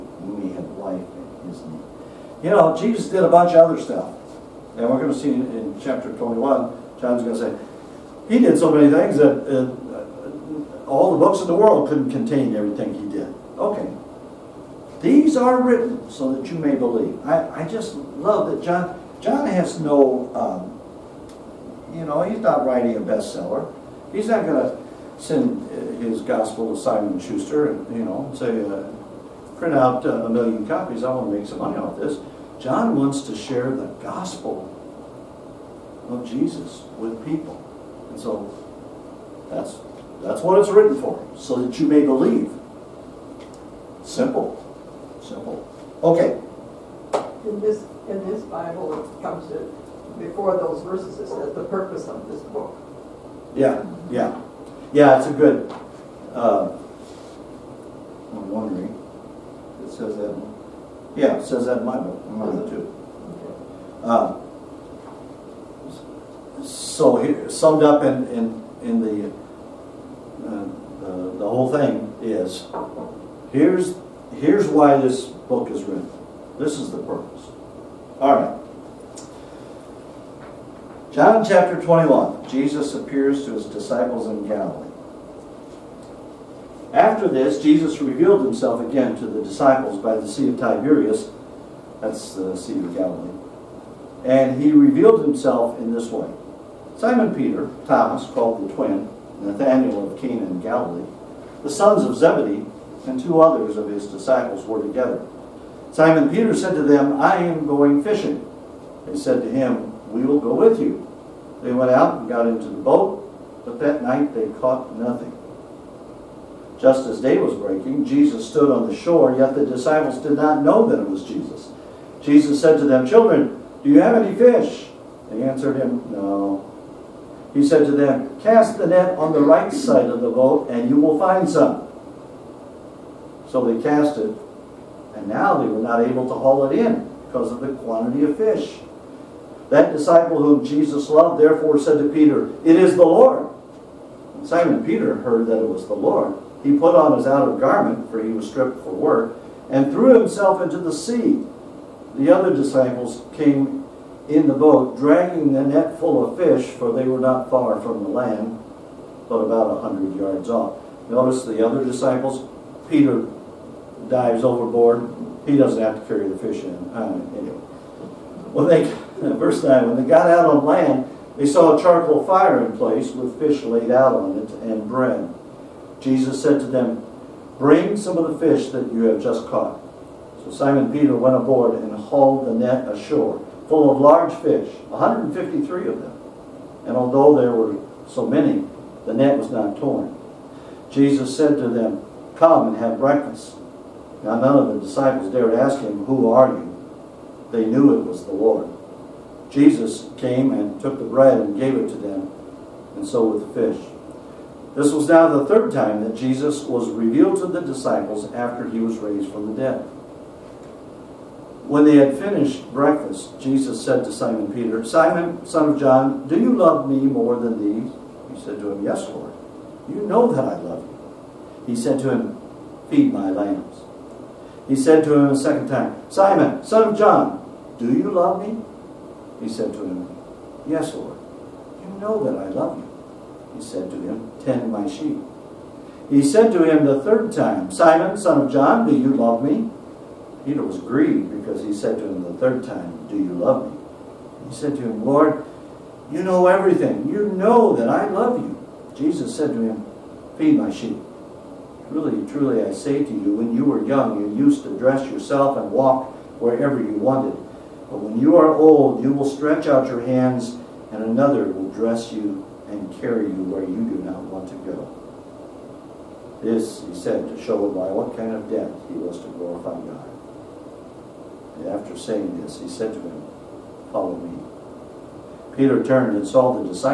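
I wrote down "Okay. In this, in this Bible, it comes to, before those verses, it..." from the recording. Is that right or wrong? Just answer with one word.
right.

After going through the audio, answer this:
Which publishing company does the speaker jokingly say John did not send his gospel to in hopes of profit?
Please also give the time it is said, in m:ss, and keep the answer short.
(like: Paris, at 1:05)
Simon Schuster, at 0:26.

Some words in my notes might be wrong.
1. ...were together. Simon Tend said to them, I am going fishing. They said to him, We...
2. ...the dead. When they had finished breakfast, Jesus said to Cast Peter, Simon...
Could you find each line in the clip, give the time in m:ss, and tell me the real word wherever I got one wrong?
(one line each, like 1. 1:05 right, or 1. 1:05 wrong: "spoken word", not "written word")
1. 1:44 wrong: "Peter", not "Tend"
2. 3:29 wrong: "Simon", not "Cast".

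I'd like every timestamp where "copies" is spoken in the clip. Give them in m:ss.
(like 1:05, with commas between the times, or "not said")
0:30.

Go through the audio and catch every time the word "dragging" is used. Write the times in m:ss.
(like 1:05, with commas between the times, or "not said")
2:34.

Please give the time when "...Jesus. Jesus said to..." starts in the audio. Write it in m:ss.
2:01.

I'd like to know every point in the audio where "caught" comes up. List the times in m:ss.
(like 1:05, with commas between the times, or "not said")
1:54, 2:59.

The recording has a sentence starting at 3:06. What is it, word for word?
And although there were so many, the net was not torn.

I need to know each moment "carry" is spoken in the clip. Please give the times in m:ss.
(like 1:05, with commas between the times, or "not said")
2:46, 4:22.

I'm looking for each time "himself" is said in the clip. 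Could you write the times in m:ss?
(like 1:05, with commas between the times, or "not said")
1:28, 1:35, 2:30.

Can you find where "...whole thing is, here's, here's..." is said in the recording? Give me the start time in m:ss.
1:11.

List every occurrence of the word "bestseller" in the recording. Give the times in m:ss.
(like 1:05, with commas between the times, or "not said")
0:23.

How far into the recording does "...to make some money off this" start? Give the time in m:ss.
0:31.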